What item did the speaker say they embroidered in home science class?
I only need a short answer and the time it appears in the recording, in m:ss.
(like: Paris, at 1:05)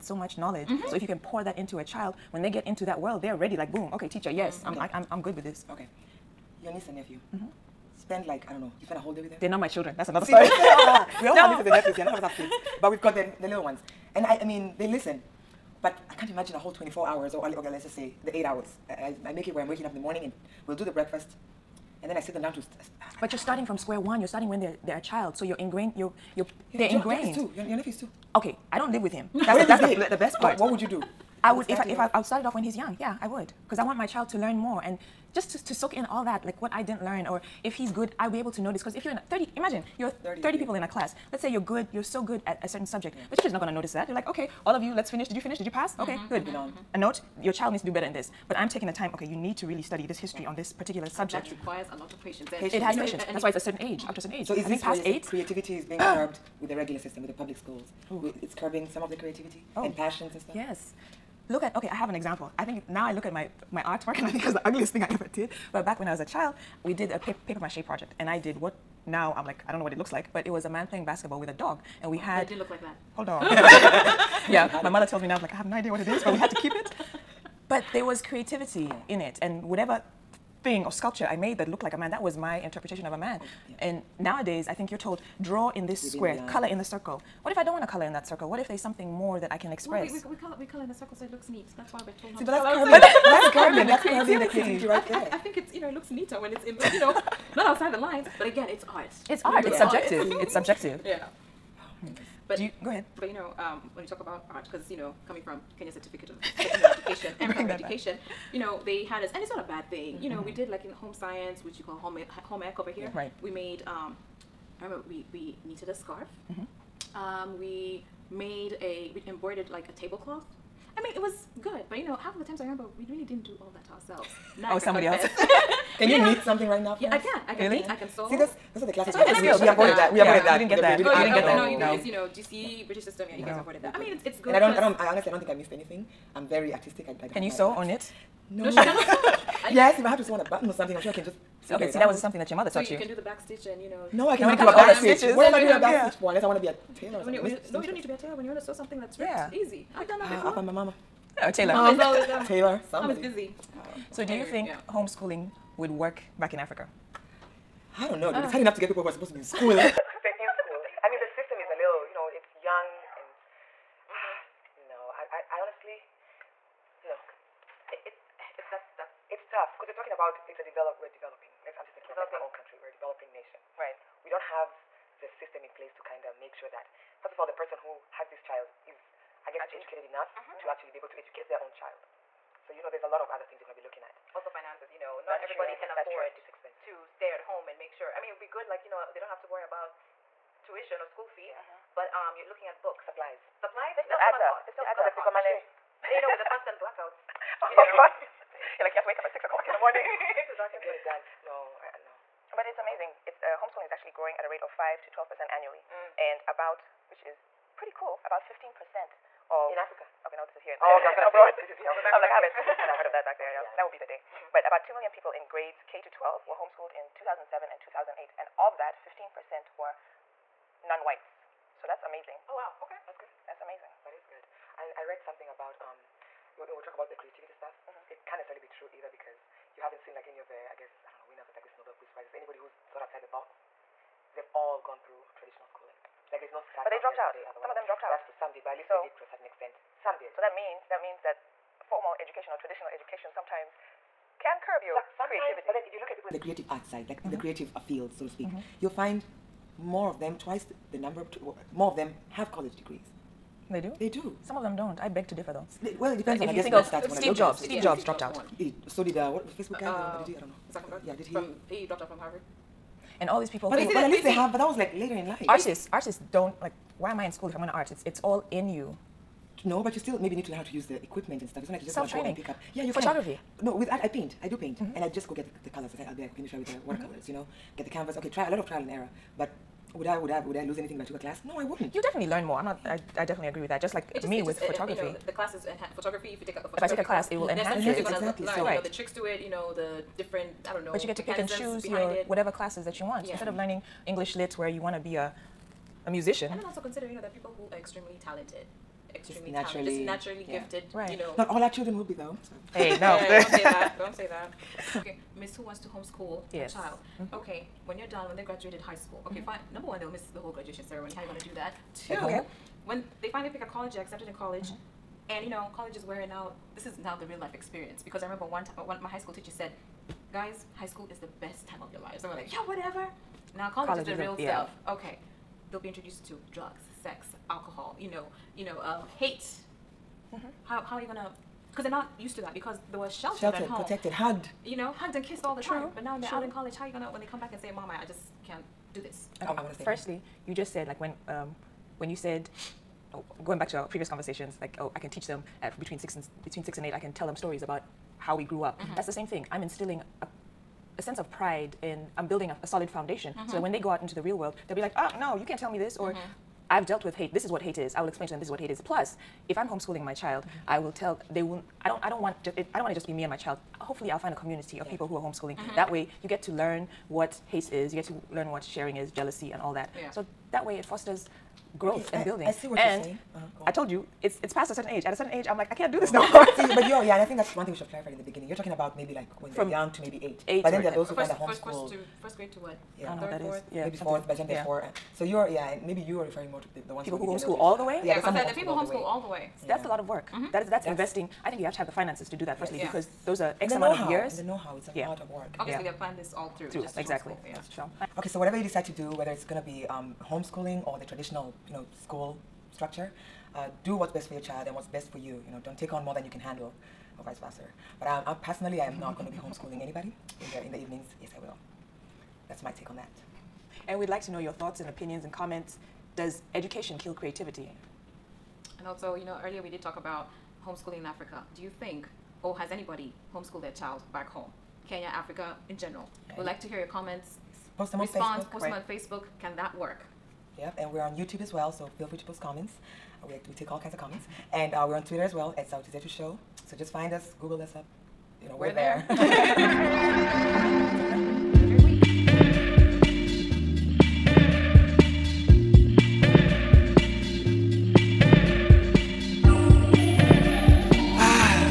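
A tablecloth, at 1:59.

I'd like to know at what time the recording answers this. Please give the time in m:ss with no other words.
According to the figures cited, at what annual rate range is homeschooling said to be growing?
3:24.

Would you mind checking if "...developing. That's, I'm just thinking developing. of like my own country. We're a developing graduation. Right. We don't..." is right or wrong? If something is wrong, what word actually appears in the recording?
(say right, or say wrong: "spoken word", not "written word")
wrong: "nation", not "graduation".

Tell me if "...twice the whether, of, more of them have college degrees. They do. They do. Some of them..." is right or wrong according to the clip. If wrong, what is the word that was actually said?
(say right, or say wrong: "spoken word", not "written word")
wrong: "number", not "whether".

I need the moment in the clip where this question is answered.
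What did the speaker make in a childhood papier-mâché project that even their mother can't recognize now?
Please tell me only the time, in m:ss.
1:10.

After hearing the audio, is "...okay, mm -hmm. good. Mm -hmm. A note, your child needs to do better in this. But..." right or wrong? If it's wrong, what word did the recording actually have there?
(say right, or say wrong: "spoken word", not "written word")
right.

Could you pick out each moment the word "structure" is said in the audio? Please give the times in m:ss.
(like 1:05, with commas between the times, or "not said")
6:42.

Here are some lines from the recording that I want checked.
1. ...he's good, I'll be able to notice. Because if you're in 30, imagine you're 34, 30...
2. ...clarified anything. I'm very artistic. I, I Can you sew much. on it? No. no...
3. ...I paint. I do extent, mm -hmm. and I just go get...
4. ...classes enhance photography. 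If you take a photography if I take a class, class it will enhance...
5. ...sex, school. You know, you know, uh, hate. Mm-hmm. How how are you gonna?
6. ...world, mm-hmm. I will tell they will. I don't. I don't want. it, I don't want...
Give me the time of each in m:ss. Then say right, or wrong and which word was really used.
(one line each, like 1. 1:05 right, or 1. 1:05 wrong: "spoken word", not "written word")
1. 0:37 wrong: "30", not "34"
2. 2:15 wrong: "missed", not "clarified"
3. 4:34 wrong: "paint", not "extent"
4. 4:45 right
5. 5:27 wrong: "alcohol", not "school"
6. 6:00 wrong: "child", not "world".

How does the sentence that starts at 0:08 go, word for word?
You spend a whole day with them.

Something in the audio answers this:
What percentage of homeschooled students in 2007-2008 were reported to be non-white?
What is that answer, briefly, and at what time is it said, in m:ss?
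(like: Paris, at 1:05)
15%, at 3:39.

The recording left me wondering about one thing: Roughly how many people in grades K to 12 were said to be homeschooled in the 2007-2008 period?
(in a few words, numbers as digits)
2 million.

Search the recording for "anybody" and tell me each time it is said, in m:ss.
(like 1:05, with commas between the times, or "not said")
3:52, 6:49, 7:02.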